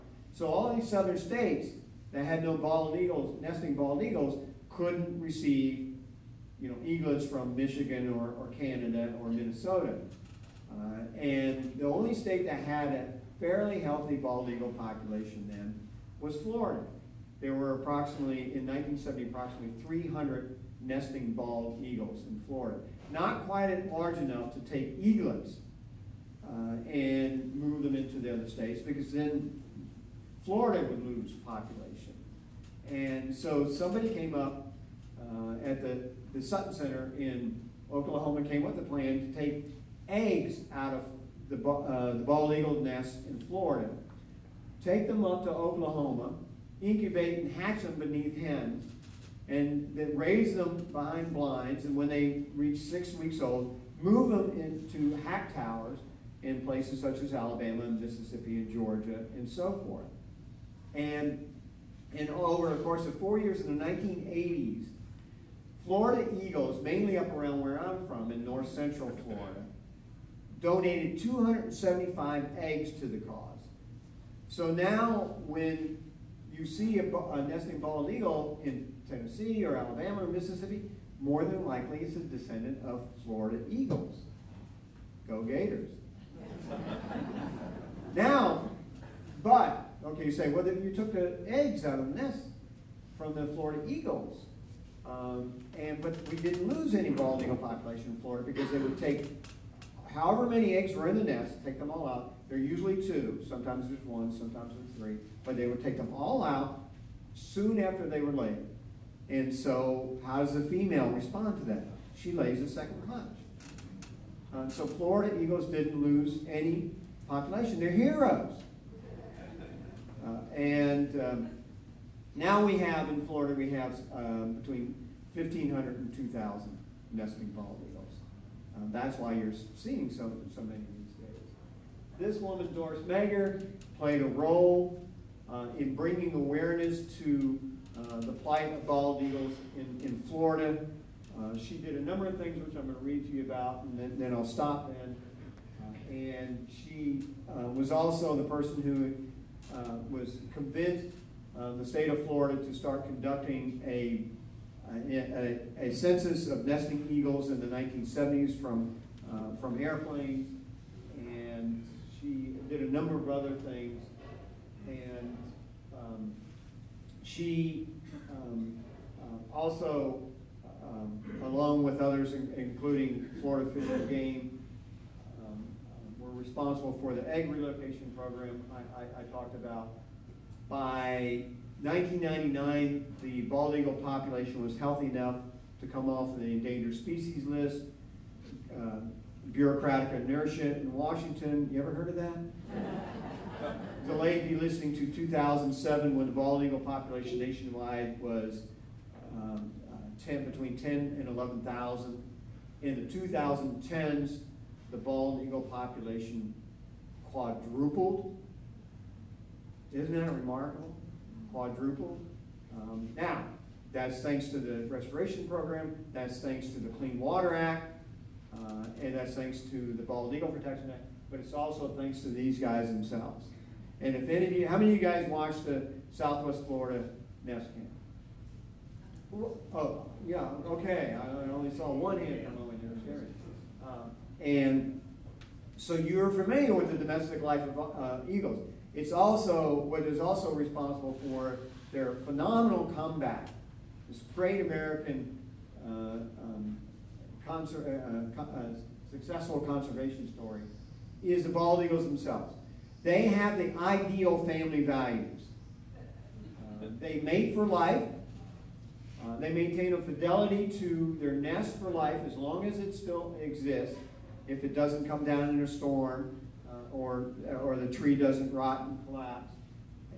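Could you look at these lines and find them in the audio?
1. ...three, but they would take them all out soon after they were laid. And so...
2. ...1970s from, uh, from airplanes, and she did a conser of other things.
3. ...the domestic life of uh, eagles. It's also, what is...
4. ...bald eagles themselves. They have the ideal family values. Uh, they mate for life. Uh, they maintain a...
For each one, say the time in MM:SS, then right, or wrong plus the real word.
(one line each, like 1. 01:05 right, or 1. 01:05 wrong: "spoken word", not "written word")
1. 01:44 right
2. 02:37 wrong: "number", not "conser"
3. 03:56 right
4. 04:11 right.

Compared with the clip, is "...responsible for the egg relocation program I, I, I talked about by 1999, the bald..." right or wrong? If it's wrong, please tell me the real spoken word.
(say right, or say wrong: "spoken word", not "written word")
right.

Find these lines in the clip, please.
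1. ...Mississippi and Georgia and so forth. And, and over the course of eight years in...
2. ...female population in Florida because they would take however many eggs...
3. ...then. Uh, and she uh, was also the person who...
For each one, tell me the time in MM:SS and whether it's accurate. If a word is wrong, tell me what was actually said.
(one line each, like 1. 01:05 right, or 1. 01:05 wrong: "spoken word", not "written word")
1. 00:58 wrong: "four", not "eight"
2. 01:37 wrong: "eagle", not "female"
3. 02:24 right.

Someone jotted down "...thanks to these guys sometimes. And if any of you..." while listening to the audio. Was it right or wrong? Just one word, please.
wrong.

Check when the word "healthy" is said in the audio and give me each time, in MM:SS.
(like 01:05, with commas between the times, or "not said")
00:13, 03:04.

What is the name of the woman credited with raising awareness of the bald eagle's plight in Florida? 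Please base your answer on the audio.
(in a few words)
Doris Mager.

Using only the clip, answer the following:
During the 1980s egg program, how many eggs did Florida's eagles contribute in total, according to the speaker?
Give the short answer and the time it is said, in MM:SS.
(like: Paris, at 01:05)
275, at 01:11.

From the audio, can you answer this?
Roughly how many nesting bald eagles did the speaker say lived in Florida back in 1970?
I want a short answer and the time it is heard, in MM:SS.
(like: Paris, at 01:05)
300, at 00:19.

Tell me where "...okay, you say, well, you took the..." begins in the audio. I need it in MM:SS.
01:30.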